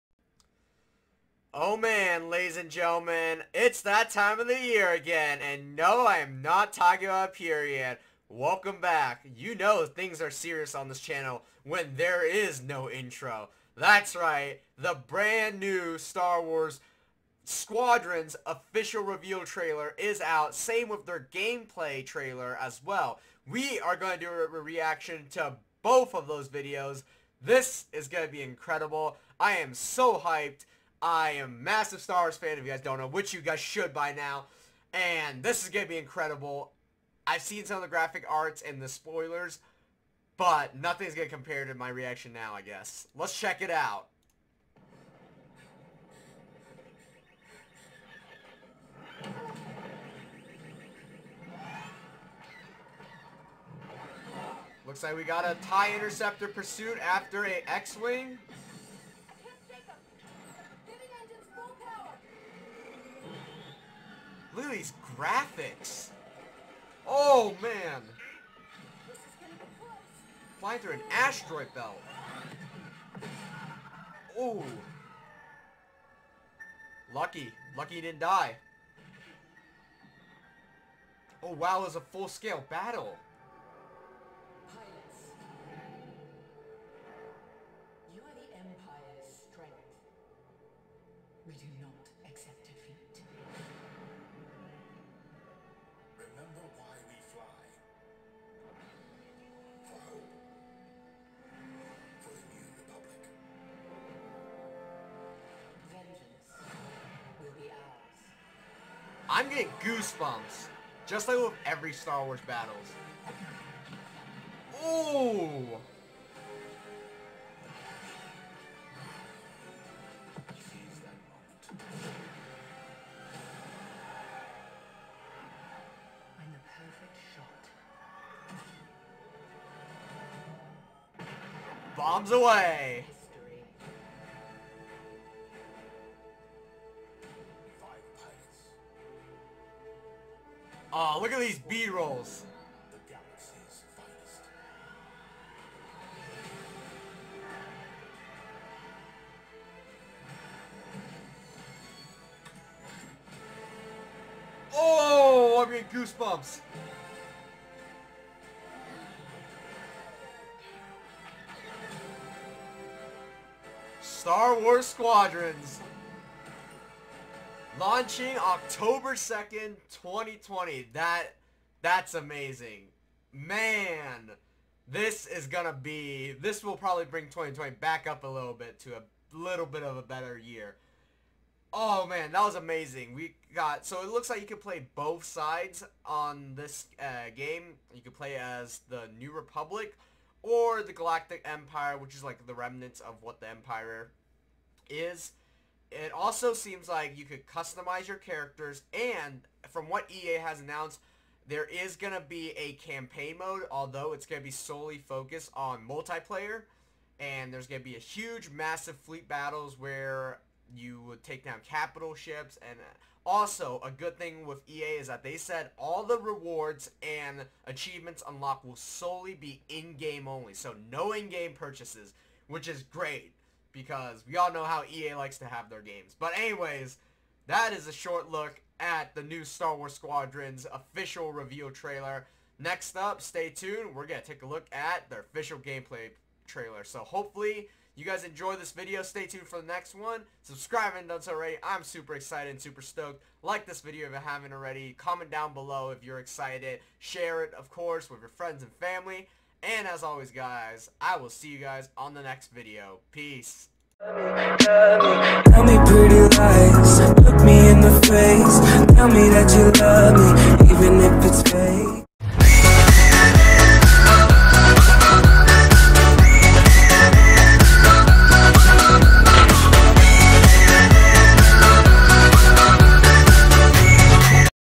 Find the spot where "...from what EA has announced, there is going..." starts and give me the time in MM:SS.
03:19.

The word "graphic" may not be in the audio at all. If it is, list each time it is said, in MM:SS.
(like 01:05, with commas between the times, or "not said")
00:37, 01:05.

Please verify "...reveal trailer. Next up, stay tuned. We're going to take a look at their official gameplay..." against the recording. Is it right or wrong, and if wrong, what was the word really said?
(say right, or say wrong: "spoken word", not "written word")
right.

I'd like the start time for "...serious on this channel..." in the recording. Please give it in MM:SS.
00:10.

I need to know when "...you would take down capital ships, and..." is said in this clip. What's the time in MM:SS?
03:30.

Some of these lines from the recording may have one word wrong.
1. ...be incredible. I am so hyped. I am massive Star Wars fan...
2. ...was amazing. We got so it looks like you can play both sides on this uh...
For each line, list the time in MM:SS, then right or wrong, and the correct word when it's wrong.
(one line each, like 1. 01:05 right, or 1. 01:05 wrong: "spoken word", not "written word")
1. 00:28 right
2. 03:02 right.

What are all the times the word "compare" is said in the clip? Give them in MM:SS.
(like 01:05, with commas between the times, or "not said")
00:41.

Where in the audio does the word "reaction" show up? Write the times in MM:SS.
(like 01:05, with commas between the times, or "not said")
00:24, 00:41.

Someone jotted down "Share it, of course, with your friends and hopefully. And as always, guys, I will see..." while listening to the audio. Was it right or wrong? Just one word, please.
wrong.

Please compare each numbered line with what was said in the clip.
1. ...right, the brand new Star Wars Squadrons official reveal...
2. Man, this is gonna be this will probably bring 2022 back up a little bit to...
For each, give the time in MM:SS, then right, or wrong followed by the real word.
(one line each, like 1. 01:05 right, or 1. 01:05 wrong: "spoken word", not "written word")
1. 00:14 right
2. 02:53 wrong: "2020", not "2022".